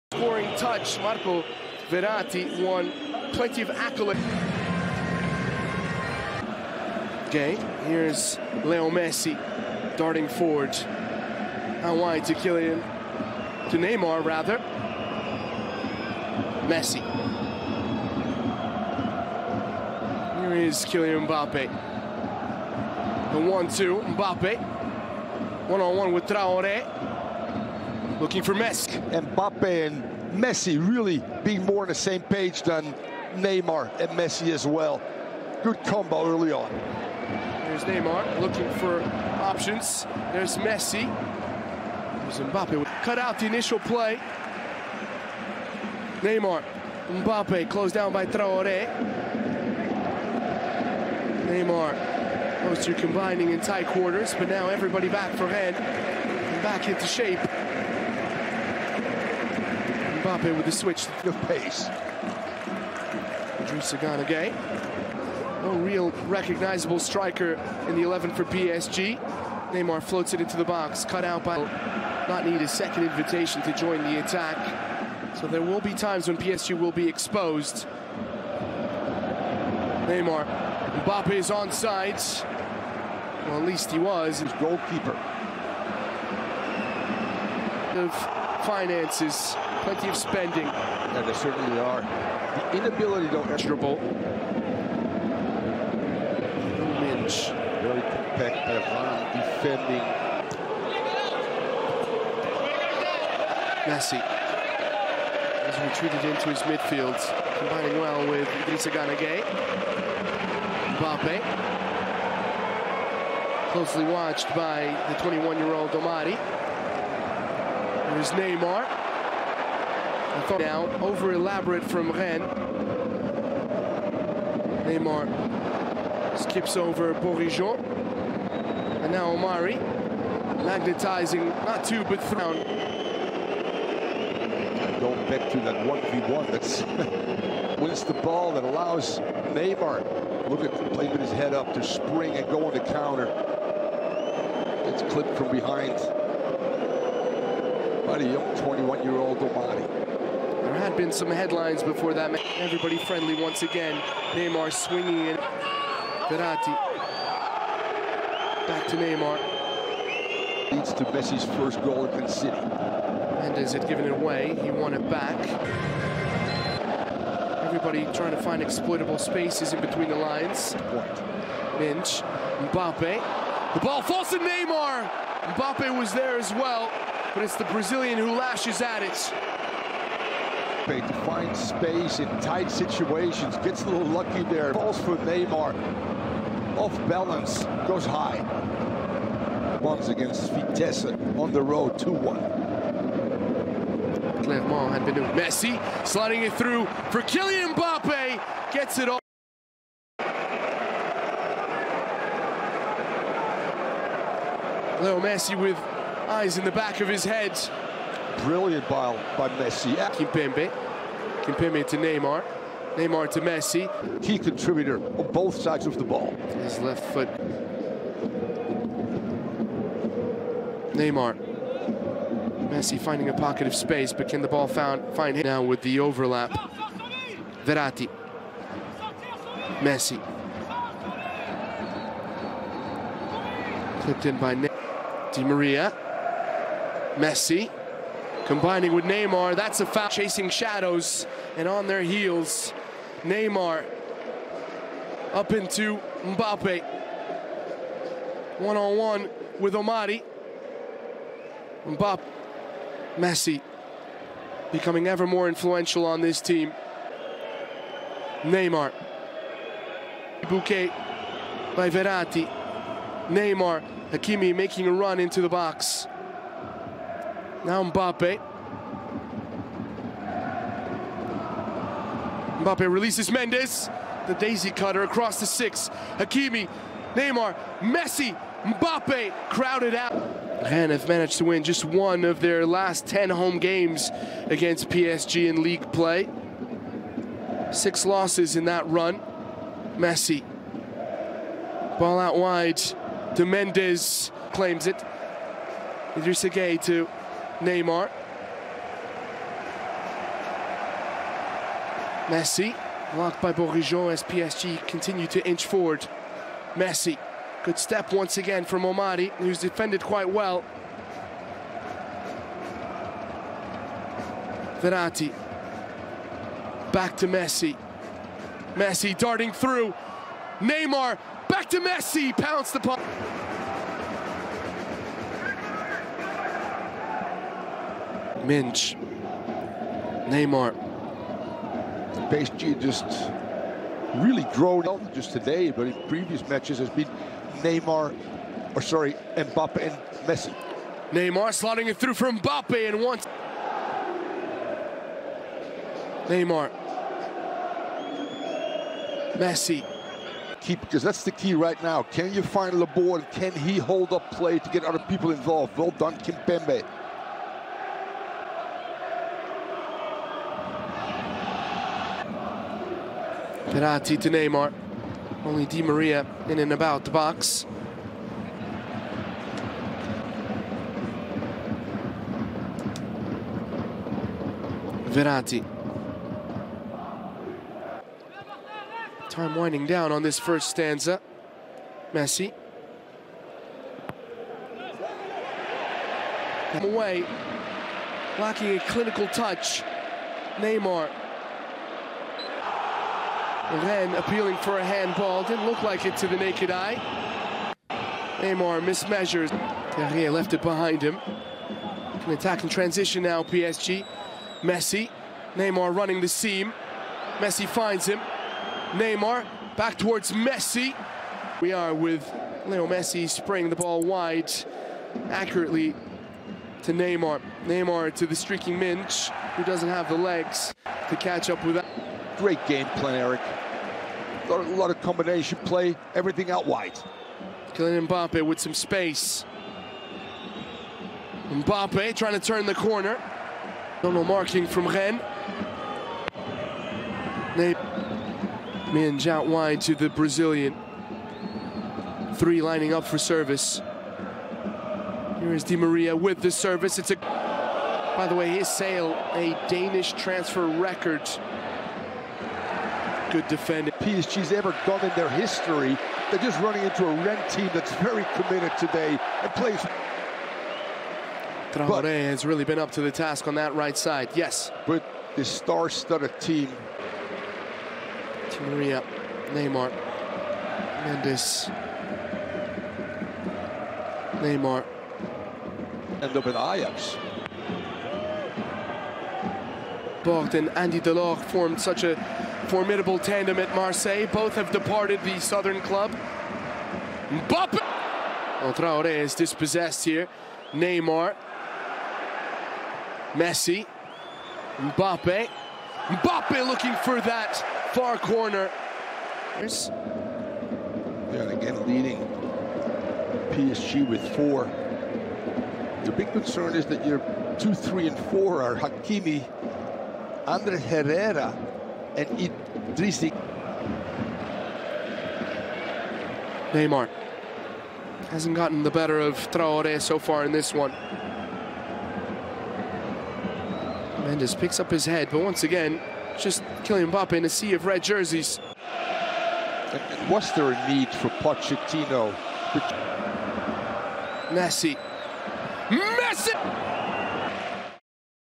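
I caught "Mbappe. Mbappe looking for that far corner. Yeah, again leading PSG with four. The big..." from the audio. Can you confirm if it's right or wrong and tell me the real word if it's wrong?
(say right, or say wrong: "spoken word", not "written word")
right.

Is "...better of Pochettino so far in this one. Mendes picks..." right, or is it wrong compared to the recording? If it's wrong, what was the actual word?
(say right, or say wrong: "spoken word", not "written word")
wrong: "Traore", not "Pochettino".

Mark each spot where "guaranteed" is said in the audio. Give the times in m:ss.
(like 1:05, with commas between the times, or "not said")
not said.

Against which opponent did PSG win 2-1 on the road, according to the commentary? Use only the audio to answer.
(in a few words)
Vitesse.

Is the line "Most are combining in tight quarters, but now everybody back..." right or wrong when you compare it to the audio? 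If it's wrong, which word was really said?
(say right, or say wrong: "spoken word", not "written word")
right.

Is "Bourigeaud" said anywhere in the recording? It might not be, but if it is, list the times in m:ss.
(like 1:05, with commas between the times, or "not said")
2:07, 5:03.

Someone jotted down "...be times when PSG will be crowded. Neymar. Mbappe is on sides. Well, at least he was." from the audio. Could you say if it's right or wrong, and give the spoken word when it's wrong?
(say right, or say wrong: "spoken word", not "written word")
wrong: "exposed", not "crowded".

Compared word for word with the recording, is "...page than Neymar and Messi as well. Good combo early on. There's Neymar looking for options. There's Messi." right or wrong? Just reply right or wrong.
right.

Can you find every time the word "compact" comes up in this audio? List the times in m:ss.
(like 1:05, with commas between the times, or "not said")
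1:38.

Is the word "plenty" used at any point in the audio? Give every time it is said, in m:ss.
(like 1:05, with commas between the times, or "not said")
0:03, 1:29.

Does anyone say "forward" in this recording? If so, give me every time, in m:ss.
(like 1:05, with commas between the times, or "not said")
0:10, 5:05.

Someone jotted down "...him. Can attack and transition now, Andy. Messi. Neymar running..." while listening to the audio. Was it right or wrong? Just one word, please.
wrong.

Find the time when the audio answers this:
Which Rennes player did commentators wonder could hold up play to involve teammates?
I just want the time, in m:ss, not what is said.
5:52.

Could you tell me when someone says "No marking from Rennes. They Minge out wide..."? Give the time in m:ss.
7:14.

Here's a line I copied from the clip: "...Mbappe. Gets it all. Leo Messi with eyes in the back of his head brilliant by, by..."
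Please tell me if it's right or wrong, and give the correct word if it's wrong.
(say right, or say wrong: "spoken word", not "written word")
right.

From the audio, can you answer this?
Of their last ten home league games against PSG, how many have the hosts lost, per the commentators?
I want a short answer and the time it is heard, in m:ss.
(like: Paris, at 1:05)
6, at 4:47.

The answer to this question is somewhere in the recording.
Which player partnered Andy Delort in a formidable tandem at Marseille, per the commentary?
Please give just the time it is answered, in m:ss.
8:00.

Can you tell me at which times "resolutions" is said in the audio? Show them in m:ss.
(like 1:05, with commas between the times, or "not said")
not said.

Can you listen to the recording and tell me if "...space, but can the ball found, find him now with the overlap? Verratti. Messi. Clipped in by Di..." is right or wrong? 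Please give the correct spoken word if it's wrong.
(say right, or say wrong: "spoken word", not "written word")
right.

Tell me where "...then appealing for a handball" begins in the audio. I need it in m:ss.
6:33.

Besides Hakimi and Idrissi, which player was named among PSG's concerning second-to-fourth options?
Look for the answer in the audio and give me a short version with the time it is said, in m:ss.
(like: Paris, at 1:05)
Ander Herrera, at 8:30.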